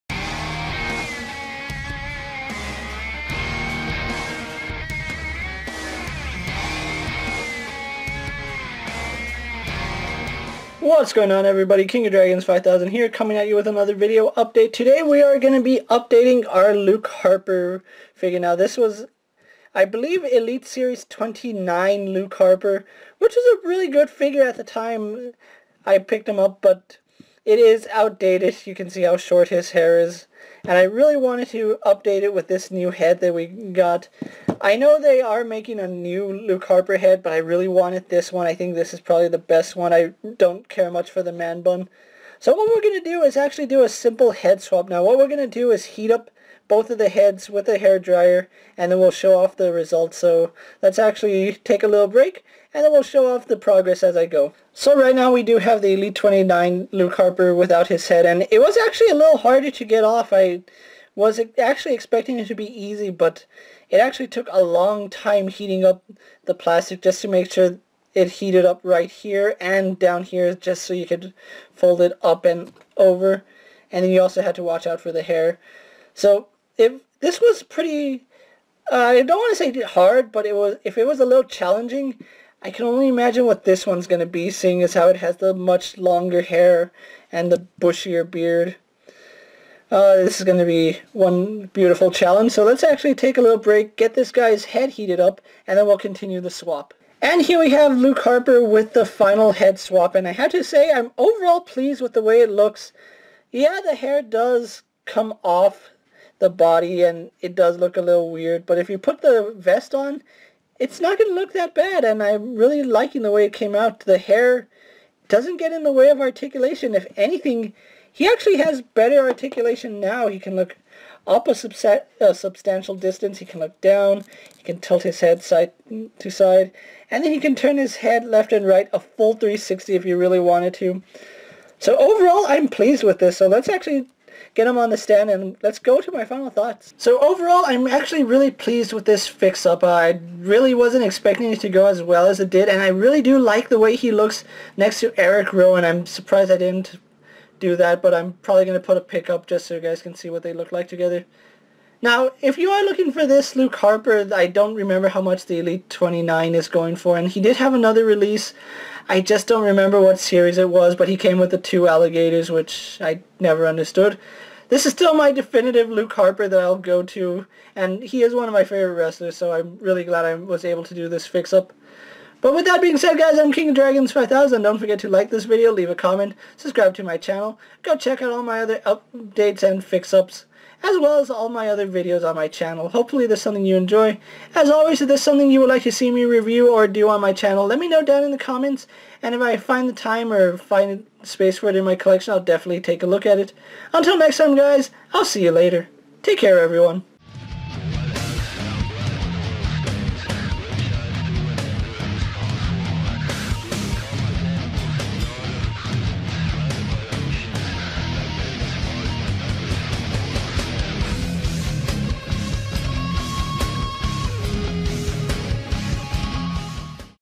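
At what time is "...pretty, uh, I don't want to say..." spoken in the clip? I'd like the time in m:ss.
1:17.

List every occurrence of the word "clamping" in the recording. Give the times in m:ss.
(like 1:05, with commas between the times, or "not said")
not said.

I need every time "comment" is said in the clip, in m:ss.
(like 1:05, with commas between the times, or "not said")
2:55, 3:08.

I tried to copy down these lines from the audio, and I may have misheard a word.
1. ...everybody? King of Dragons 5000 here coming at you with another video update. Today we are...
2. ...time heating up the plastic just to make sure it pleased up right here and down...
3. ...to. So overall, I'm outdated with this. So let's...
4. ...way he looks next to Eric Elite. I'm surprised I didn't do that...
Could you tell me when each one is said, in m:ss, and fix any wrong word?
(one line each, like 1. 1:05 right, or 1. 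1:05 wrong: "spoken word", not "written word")
1. 0:11 right
2. 1:05 wrong: "heated", not "pleased"
3. 2:10 wrong: "pleased", not "outdated"
4. 2:23 wrong: "Rowan", not "Elite".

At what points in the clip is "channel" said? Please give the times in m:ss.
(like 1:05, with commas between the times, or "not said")
2:57, 3:02, 3:07.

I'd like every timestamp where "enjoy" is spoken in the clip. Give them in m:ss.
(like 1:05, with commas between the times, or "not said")
3:03.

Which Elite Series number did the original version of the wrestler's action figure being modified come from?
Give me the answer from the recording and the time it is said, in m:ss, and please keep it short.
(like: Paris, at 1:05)
29, at 0:20.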